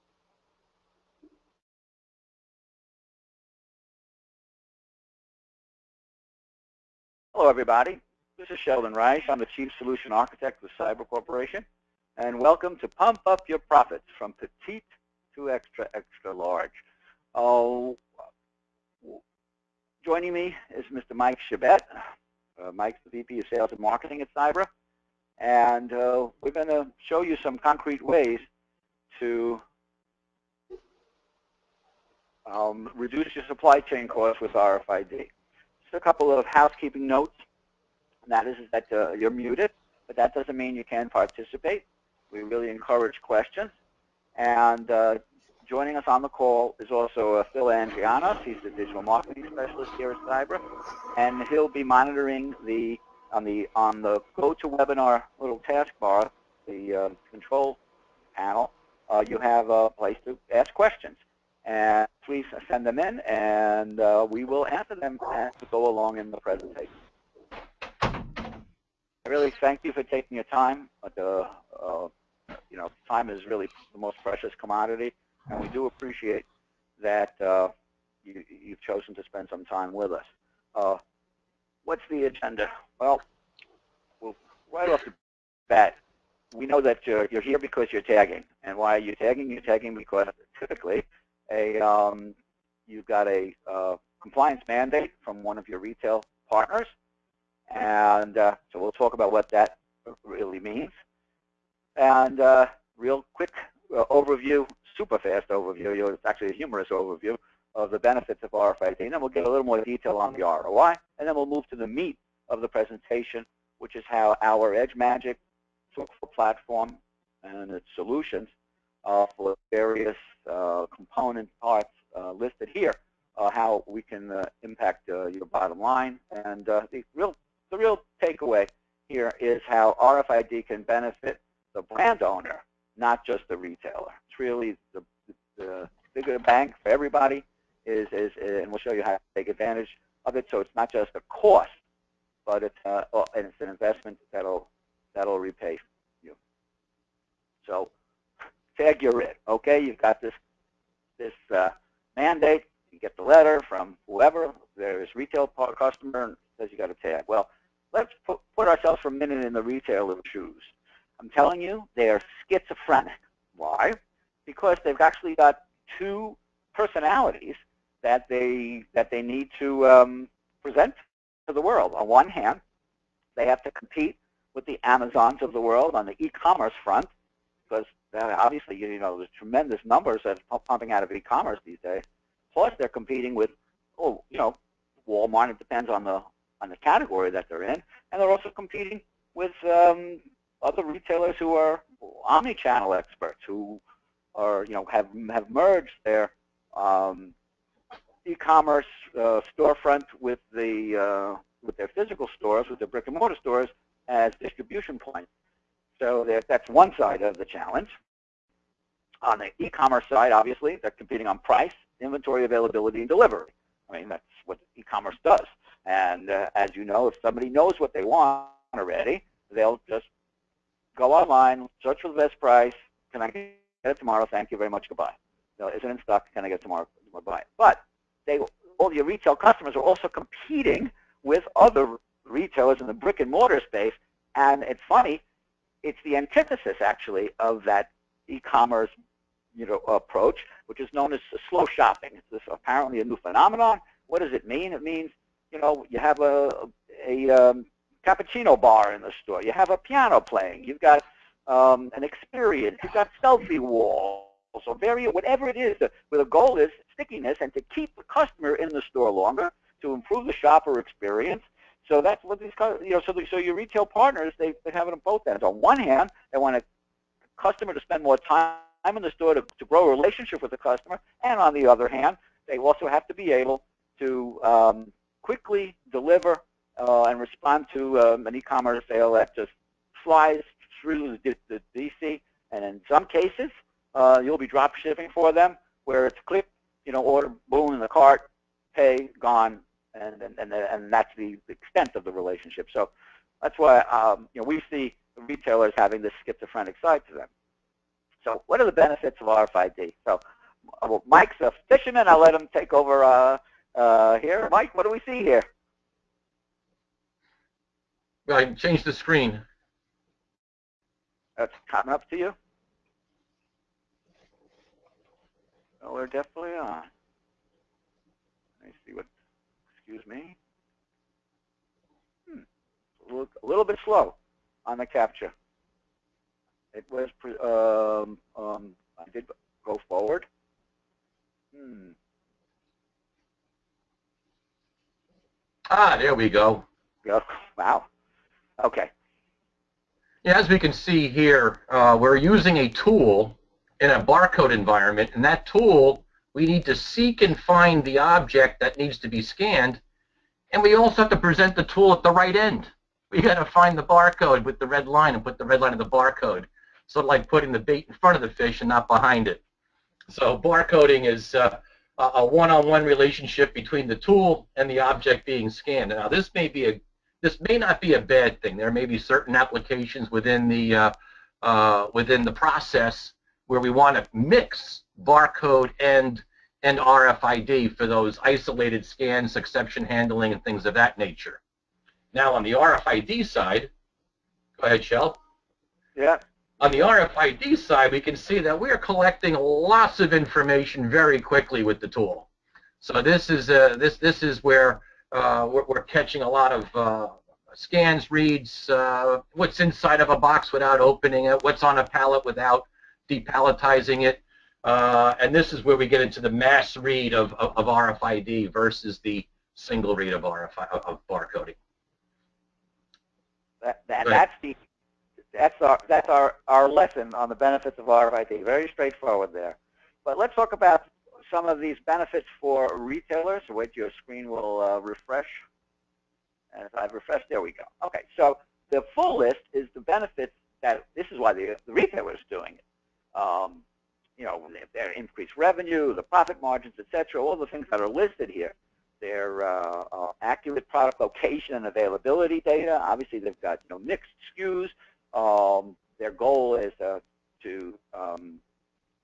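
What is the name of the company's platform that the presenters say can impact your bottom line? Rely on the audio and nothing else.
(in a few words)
EdgeMagic.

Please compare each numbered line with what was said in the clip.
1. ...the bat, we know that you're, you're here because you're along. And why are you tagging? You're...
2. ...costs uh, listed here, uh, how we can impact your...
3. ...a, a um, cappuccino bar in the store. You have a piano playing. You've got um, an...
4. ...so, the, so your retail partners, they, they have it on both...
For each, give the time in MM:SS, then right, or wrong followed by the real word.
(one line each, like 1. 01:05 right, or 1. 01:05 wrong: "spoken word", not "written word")
1. 01:25 wrong: "tagging", not "along"
2. 02:01 wrong: "parts", not "costs"
3. 04:06 right
4. 04:23 right.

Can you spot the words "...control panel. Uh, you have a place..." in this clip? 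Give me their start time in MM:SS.
00:57.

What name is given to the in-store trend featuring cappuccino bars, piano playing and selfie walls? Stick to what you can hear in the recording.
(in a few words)
slow shopping.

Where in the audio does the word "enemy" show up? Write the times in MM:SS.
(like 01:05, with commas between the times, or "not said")
not said.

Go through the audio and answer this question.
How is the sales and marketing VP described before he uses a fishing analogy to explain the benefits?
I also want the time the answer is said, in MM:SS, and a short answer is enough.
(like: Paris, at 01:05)
fisherman, at 05:01.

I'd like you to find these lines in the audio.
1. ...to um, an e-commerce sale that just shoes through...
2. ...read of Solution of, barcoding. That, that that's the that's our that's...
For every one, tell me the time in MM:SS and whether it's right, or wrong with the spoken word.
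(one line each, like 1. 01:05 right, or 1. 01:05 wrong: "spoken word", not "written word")
1. 04:37 wrong: "flies", not "shoes"
2. 06:49 wrong: "RFID", not "Solution".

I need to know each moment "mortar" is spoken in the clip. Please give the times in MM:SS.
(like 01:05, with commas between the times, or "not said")
03:23, 03:53.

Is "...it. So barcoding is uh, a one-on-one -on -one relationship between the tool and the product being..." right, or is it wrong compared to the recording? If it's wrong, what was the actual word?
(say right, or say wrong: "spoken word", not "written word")
wrong: "object", not "product".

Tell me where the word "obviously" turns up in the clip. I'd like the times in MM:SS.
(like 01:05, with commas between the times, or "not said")
02:58, 03:30, 07:22.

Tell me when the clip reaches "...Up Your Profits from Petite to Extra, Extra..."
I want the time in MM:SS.
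00:13.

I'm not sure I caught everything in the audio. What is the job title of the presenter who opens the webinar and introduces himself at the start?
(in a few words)
Chief Solution Architect.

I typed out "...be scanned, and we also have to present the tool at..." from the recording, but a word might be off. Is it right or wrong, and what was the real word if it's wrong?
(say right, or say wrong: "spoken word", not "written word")
right.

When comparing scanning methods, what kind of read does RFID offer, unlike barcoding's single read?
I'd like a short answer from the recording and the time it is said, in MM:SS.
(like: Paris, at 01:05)
mass read, at 06:46.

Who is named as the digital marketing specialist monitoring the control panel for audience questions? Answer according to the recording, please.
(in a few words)
Phil Andrianos.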